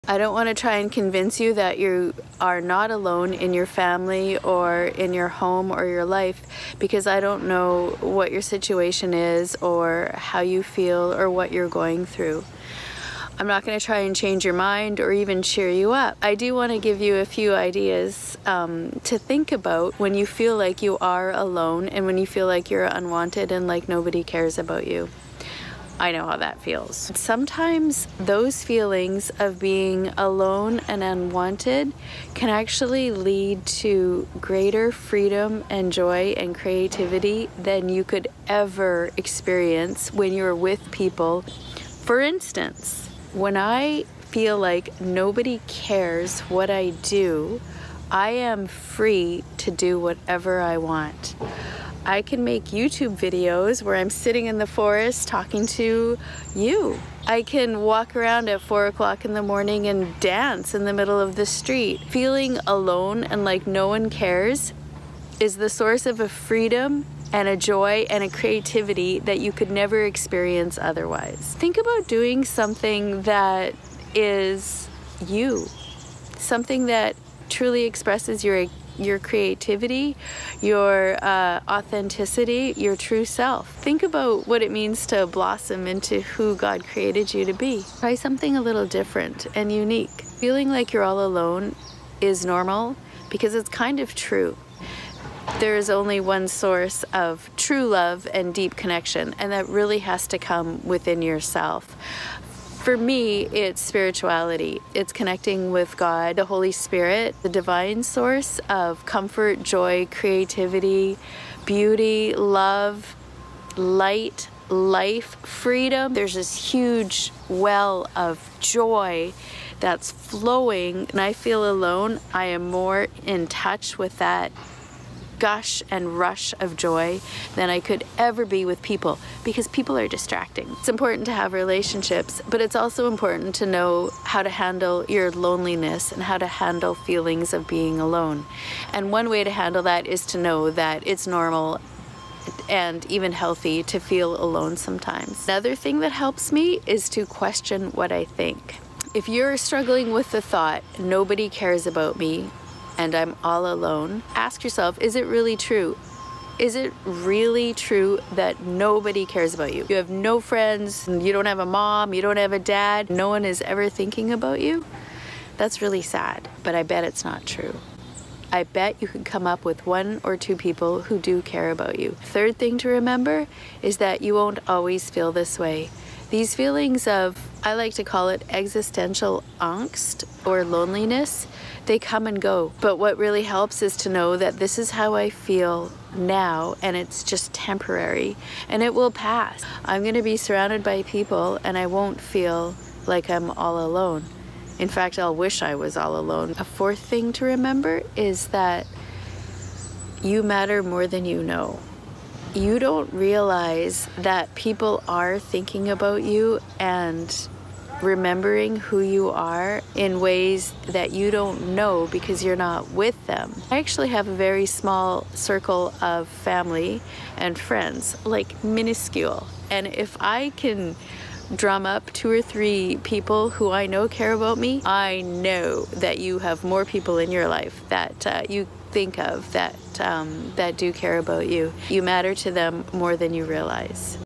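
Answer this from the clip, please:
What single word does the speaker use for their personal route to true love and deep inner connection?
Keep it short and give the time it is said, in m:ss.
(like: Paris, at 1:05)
spirituality, at 1:43.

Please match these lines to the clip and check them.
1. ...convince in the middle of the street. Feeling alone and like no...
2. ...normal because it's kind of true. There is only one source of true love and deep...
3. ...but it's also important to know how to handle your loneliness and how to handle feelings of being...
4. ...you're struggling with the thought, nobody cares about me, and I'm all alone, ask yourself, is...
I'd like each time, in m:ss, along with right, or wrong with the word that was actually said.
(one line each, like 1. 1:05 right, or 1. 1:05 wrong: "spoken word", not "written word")
1. 1:00 wrong: "dance", not "convince"
2. 1:32 right
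3. 2:12 right
4. 2:29 right.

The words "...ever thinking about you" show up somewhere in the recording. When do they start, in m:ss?
2:43.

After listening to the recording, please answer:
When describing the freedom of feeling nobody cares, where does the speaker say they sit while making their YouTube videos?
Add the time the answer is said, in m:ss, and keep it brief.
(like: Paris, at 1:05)
the forest, at 0:54.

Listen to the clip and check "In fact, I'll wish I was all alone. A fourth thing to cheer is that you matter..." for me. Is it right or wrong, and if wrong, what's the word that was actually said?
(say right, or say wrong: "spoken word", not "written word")
wrong: "remember", not "cheer".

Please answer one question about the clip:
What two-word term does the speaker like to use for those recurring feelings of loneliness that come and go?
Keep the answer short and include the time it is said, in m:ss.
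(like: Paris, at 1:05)
existential angst, at 2:58.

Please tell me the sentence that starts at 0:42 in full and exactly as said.
For instance, when I feel like nobody cares what I do, I am free to do whatever I want.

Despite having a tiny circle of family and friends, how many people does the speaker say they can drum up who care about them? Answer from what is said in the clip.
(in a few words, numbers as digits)
2 or 3.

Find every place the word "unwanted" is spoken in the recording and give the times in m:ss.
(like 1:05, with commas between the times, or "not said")
0:22, 0:31.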